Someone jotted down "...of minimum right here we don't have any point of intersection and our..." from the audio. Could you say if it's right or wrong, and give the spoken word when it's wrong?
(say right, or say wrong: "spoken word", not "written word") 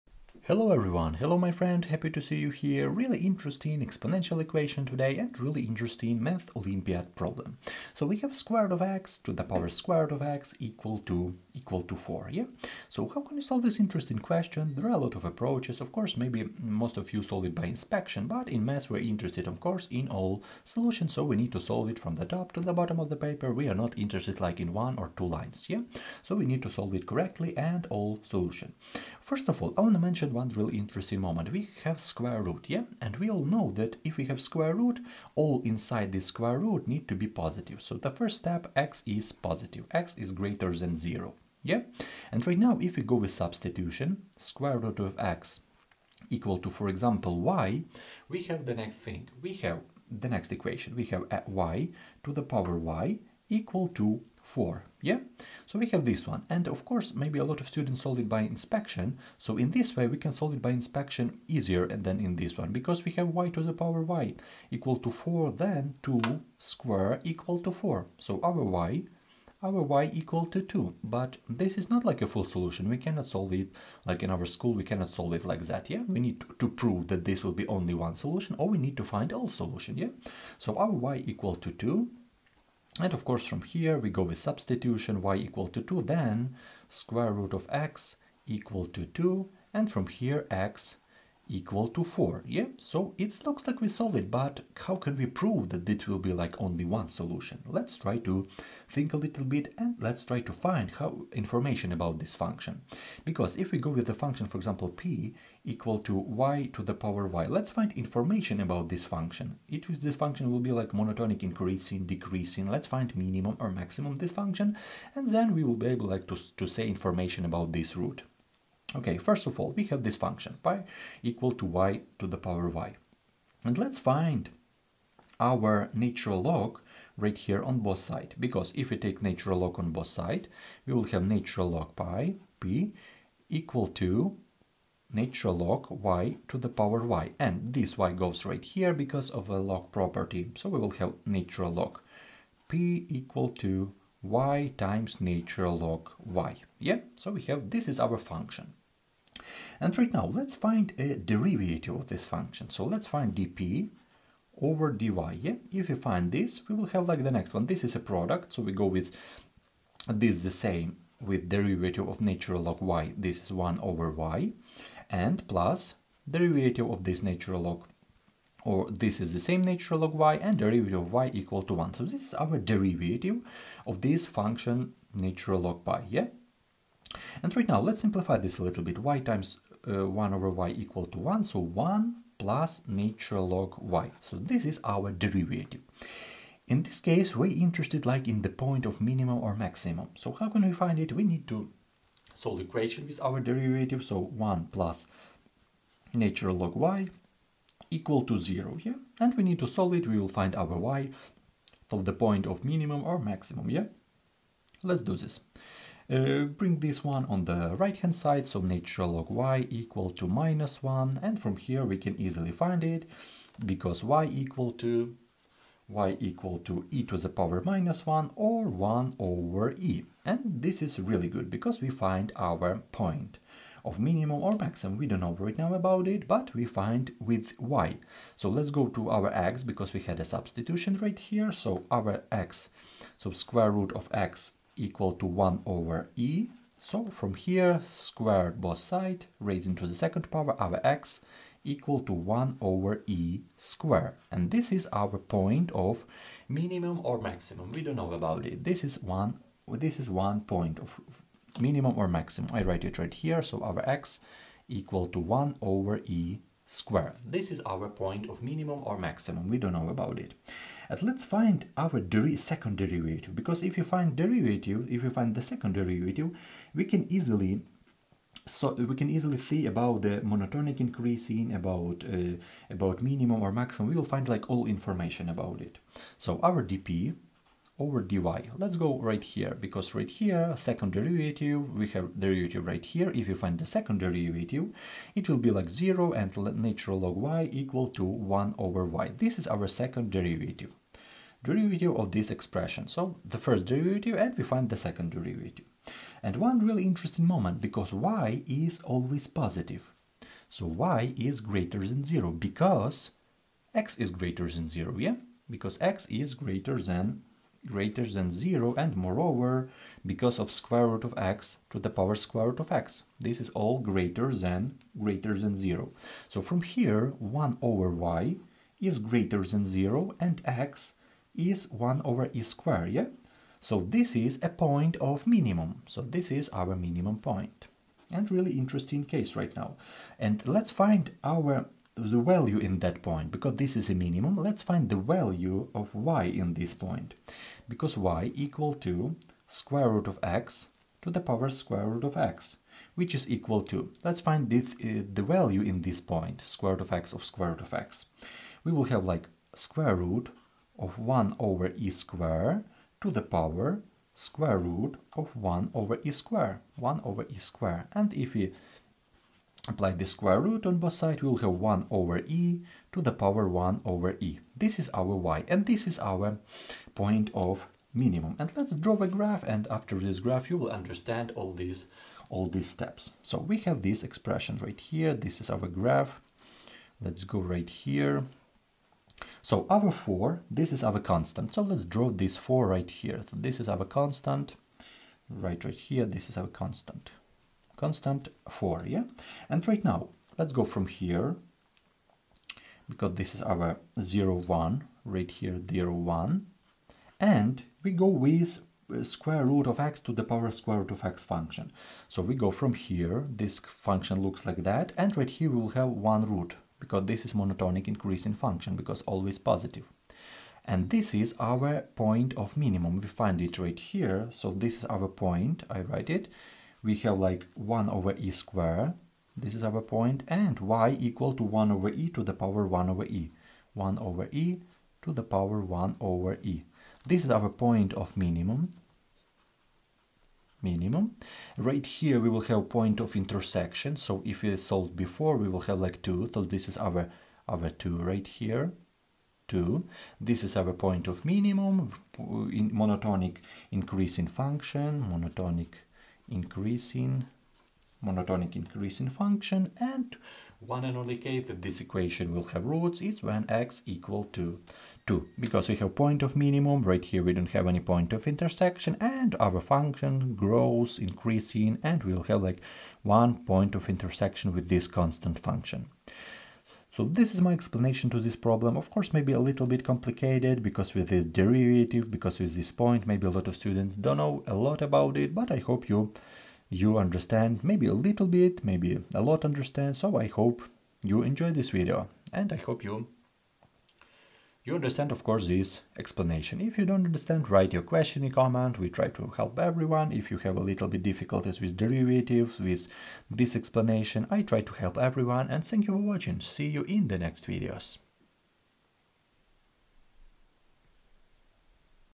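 right.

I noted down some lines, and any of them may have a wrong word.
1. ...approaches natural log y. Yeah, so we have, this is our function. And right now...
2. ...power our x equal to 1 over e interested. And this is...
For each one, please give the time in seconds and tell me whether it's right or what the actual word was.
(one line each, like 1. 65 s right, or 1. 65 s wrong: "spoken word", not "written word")
1. 144 s wrong: "times", not "approaches"
2. 240 s wrong: "squared", not "interested".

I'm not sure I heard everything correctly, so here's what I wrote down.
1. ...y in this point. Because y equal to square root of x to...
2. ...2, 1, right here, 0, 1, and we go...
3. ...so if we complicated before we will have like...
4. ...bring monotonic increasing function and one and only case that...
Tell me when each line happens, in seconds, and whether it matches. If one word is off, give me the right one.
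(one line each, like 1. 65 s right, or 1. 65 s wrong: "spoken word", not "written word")
1. 335 s right
2. 393 s wrong: "0", not "2"
3. 433 s wrong: "solved", not "complicated"
4. 446 s wrong: "increasing", not "bring".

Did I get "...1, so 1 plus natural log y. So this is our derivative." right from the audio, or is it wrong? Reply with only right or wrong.
right.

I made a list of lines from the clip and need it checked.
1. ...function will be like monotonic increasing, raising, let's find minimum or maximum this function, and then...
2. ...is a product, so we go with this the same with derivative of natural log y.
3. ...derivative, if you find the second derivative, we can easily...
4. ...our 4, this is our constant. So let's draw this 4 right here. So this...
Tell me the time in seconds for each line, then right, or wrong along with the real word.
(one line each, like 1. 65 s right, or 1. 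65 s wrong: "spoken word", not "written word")
1. 110 s wrong: "decreasing", not "raising"
2. 157 s right
3. 264 s right
4. 379 s right.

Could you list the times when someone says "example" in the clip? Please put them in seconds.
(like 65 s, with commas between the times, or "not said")
46 s, 104 s.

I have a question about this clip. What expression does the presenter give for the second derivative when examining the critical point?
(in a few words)
1/y.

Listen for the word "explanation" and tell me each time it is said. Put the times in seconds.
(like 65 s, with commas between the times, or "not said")
467 s, 485 s, 493 s.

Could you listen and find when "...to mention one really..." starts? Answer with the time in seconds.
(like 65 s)
29 s.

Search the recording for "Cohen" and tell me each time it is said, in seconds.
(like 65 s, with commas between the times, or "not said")
not said.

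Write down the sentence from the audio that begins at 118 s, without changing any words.
Okay, first of all, we have this function, pi equal to y to the power y.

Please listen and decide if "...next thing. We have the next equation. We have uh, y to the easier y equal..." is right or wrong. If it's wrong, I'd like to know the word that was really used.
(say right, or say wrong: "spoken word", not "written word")
wrong: "power", not "easier".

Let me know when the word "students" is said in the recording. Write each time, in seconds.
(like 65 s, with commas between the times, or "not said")
57 s, 473 s.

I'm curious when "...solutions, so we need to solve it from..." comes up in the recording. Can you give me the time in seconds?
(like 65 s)
20 s.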